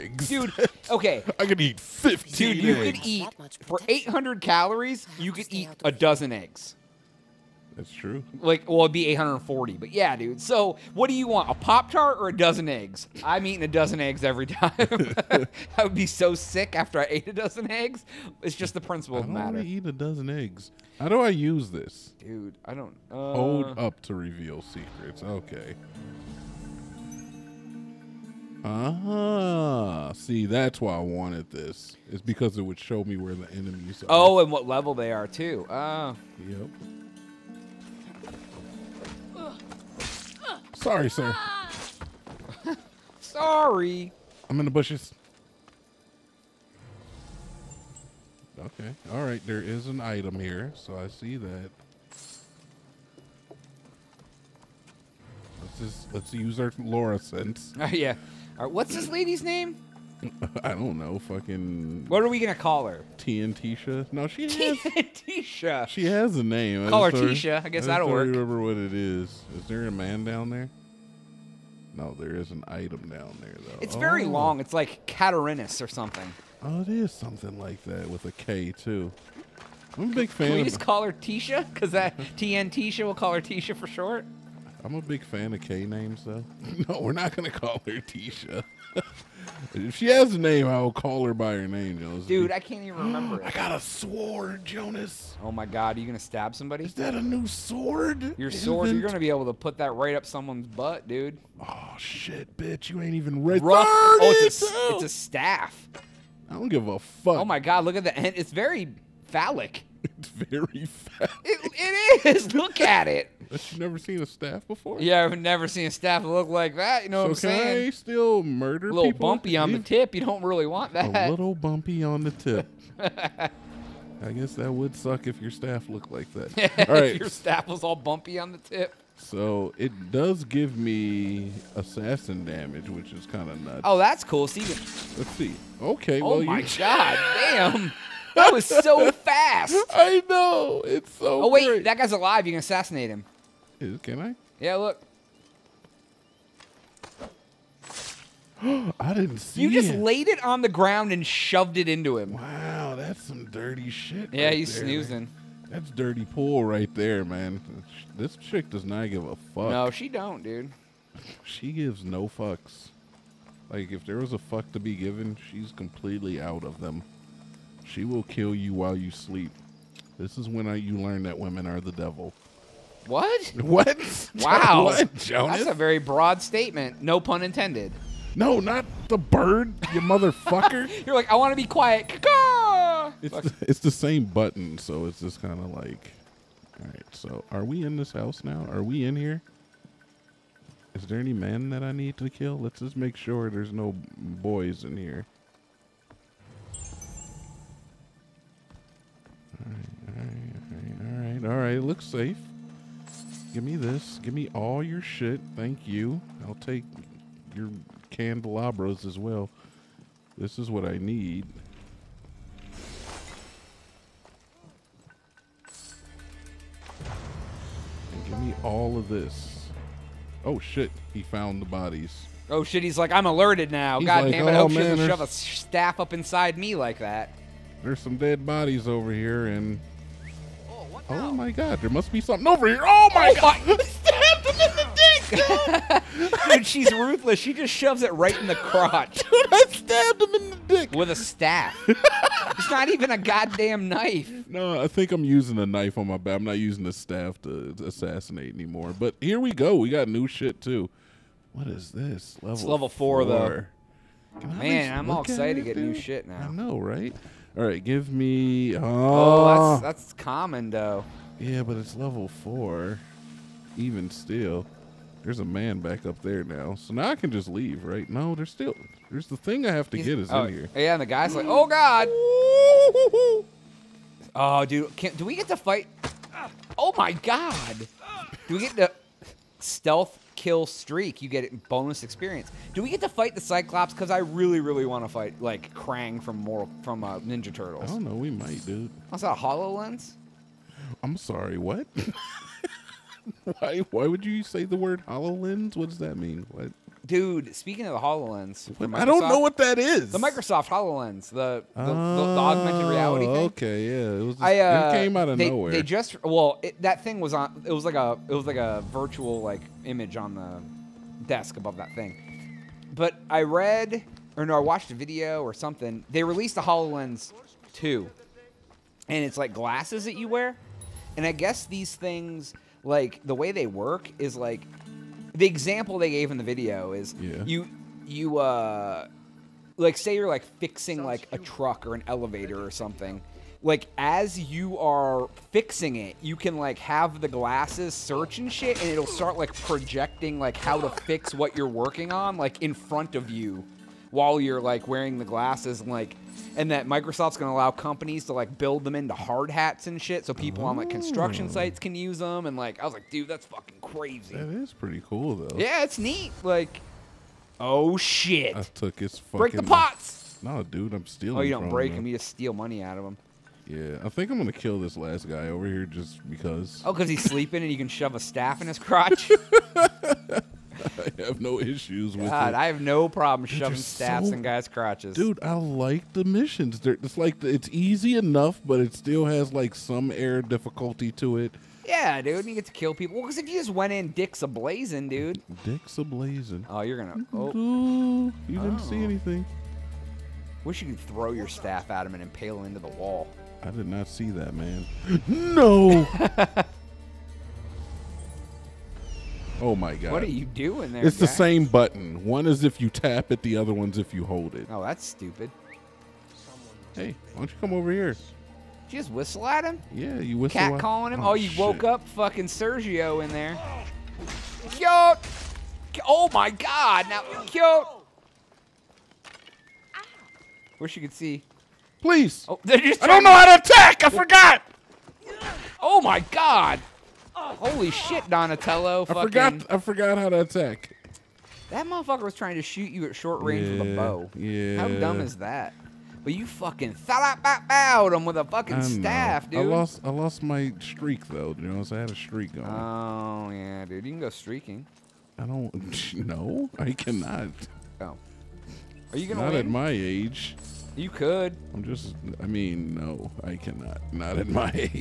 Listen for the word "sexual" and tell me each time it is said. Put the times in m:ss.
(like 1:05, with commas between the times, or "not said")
not said.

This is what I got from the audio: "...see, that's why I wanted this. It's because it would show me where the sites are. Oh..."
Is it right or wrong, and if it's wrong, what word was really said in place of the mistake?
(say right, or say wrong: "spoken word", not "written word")
wrong: "enemies", not "sites".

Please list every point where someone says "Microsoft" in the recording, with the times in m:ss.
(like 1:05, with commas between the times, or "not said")
5:00, 5:46.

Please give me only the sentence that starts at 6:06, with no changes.
Oh, because he's sleeping and you can shove a staff in his crotch.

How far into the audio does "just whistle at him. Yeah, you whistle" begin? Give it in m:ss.
6:48.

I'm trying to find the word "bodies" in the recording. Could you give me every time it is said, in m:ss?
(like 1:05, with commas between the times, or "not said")
3:41, 3:48.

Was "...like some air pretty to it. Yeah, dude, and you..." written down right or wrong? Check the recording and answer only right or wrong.
wrong.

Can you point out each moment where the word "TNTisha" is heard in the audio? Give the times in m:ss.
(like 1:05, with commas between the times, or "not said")
1:03, 1:22.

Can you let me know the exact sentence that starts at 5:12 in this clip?
But I read or no, I watched a video or something.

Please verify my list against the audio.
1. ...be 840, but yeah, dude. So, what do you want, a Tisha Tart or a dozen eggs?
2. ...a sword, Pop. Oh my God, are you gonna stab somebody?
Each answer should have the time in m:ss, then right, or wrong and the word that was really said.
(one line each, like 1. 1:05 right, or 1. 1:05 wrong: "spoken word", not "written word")
1. 0:08 wrong: "Pop", not "Tisha"
2. 1:33 wrong: "Jonaas", not "Pop".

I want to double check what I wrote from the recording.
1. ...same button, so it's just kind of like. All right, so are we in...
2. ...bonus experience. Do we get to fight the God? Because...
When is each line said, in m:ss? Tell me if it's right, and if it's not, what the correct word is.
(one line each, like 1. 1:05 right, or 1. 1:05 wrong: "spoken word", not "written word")
1. 3:03 right
2. 4:41 wrong: "Cyclops", not "God".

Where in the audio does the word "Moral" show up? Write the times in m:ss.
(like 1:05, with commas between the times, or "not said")
4:46.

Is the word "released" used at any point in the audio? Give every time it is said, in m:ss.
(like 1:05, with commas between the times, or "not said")
5:16.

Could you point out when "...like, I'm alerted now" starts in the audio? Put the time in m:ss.
3:42.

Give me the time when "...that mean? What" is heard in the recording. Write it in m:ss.
4:55.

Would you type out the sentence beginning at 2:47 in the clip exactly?
She will kill you while you sleep.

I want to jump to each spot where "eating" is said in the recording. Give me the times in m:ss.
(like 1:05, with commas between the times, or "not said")
0:13.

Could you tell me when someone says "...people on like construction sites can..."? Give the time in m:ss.
5:50.